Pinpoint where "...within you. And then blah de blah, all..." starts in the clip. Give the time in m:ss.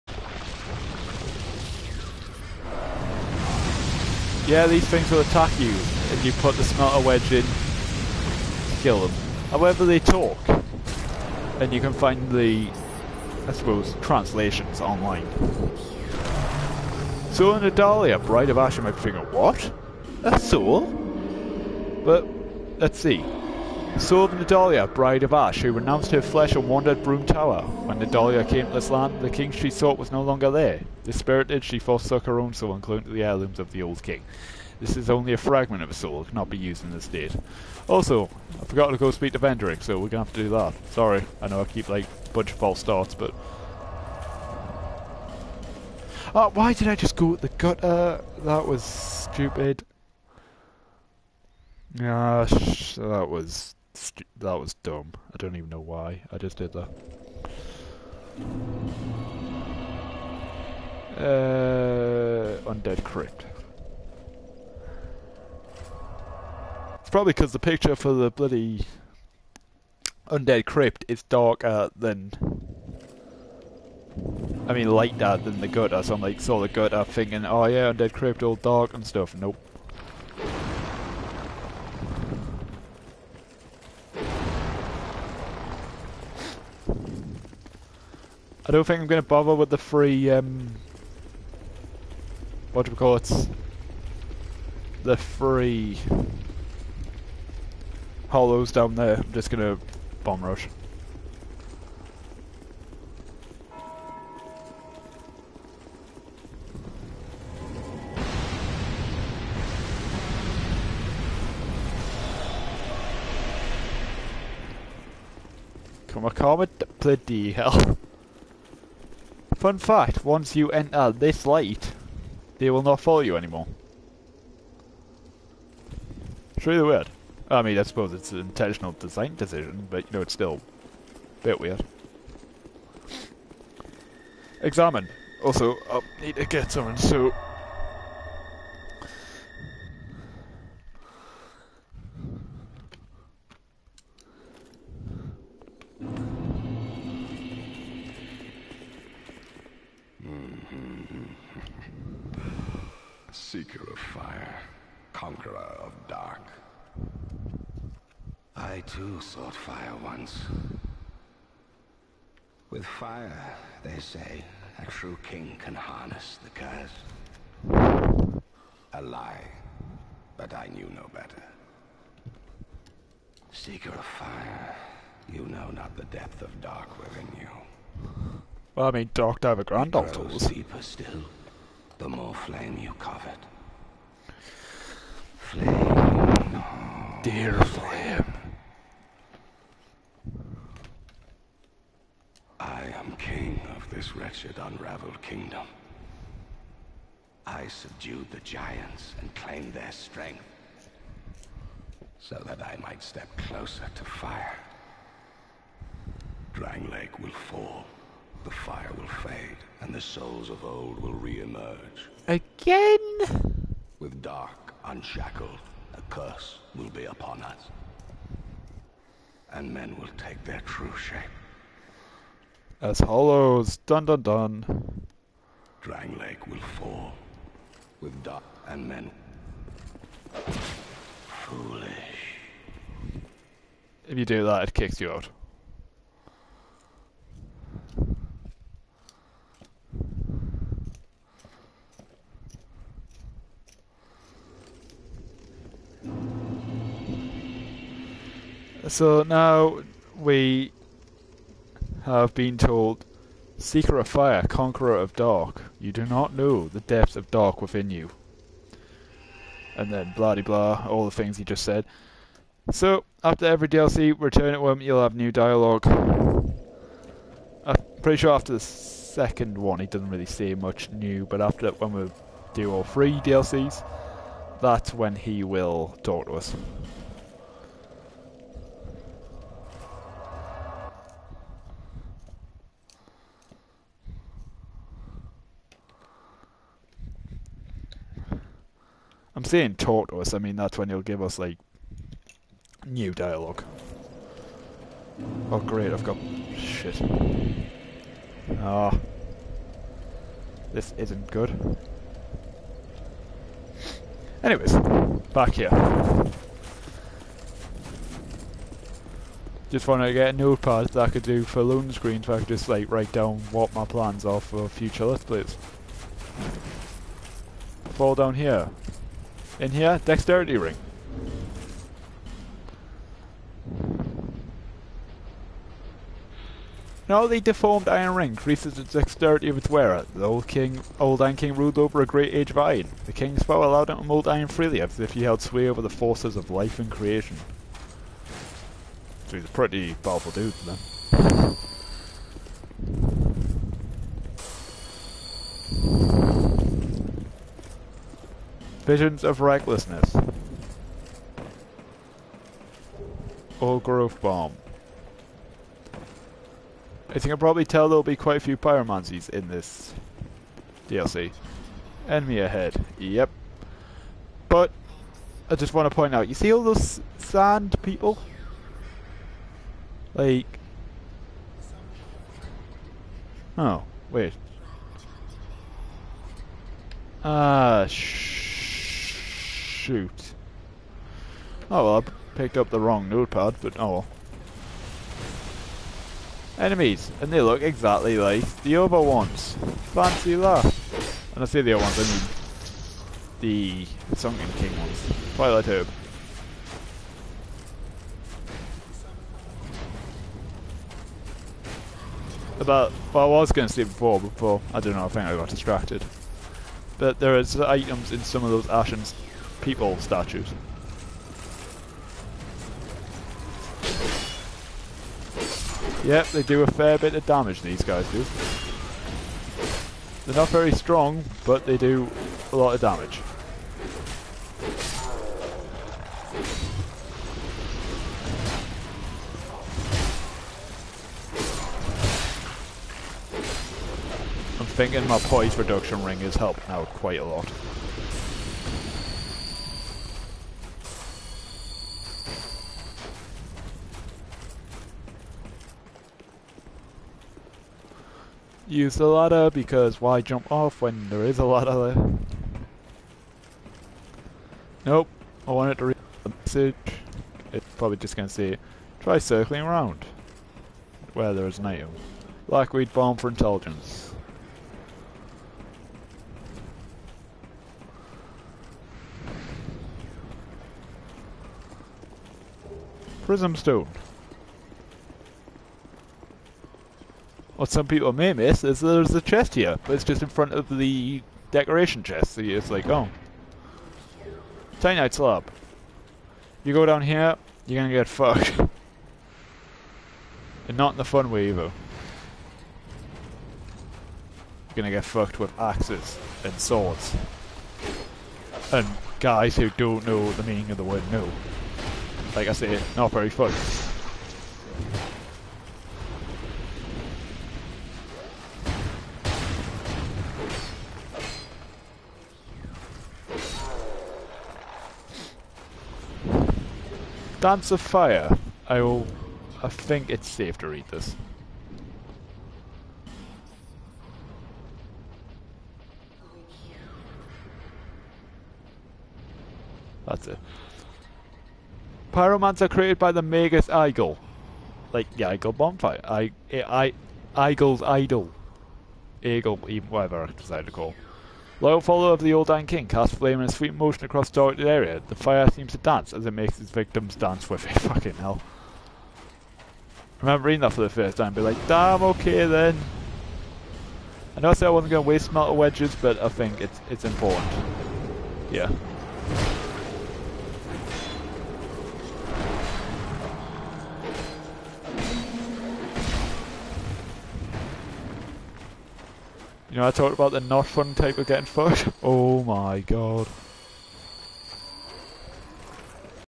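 4:17.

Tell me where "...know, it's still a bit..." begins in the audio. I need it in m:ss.
2:10.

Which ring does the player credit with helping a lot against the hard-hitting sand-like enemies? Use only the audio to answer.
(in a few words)
poise reduction ring.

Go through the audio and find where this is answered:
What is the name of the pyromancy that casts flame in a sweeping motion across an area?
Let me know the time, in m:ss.
8:37.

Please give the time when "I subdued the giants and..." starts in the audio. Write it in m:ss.
3:17.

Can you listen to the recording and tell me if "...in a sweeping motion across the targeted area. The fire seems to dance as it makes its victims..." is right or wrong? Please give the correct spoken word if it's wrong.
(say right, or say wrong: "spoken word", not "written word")
right.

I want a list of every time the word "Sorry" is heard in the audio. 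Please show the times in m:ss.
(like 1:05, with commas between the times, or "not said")
0:40.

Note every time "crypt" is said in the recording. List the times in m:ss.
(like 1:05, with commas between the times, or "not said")
1:03, 1:10, 1:18.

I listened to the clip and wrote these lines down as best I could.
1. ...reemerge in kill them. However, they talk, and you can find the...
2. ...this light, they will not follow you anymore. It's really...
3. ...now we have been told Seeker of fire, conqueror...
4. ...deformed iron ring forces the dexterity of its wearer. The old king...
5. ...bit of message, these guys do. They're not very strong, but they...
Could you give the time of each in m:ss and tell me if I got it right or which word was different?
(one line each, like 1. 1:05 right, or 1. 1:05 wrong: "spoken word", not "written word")
1. 0:07 wrong: "wedge", not "reemerge"
2. 2:01 right
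3. 4:09 right
4. 5:27 wrong: "increases", not "forces"
5. 6:56 wrong: "damage", not "message".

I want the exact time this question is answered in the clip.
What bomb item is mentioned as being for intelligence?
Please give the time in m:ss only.
7:42.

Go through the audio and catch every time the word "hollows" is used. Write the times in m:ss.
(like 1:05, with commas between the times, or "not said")
1:38, 3:42.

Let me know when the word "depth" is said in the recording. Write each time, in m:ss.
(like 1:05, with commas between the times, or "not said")
2:56, 4:16.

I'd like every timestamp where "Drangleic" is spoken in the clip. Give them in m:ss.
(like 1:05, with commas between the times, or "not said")
3:26, 3:45.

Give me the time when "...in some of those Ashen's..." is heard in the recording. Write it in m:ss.
6:48.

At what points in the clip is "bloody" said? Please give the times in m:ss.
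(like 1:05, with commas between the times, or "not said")
1:08, 1:56.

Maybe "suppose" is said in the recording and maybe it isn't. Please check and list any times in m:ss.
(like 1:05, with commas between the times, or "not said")
0:13, 2:07.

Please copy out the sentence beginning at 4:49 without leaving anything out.
I'm saying talk to us, I mean that's when he'll give us like new dialogue.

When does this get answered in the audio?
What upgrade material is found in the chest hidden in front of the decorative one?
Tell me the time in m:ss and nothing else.
8:04.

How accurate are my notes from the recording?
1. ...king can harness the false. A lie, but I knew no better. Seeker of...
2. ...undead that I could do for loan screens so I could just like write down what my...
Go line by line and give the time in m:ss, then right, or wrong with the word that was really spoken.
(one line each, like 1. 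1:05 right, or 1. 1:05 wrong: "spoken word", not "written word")
1. 2:45 wrong: "curse", not "false"
2. 5:10 wrong: "notepad", not "undead".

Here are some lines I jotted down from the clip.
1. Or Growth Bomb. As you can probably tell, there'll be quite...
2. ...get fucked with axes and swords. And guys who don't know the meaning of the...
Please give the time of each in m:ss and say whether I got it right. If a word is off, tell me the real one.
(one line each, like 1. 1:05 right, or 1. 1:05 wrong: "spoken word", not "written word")
1. 5:53 right
2. 8:14 right.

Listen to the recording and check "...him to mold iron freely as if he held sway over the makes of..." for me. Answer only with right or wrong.
wrong.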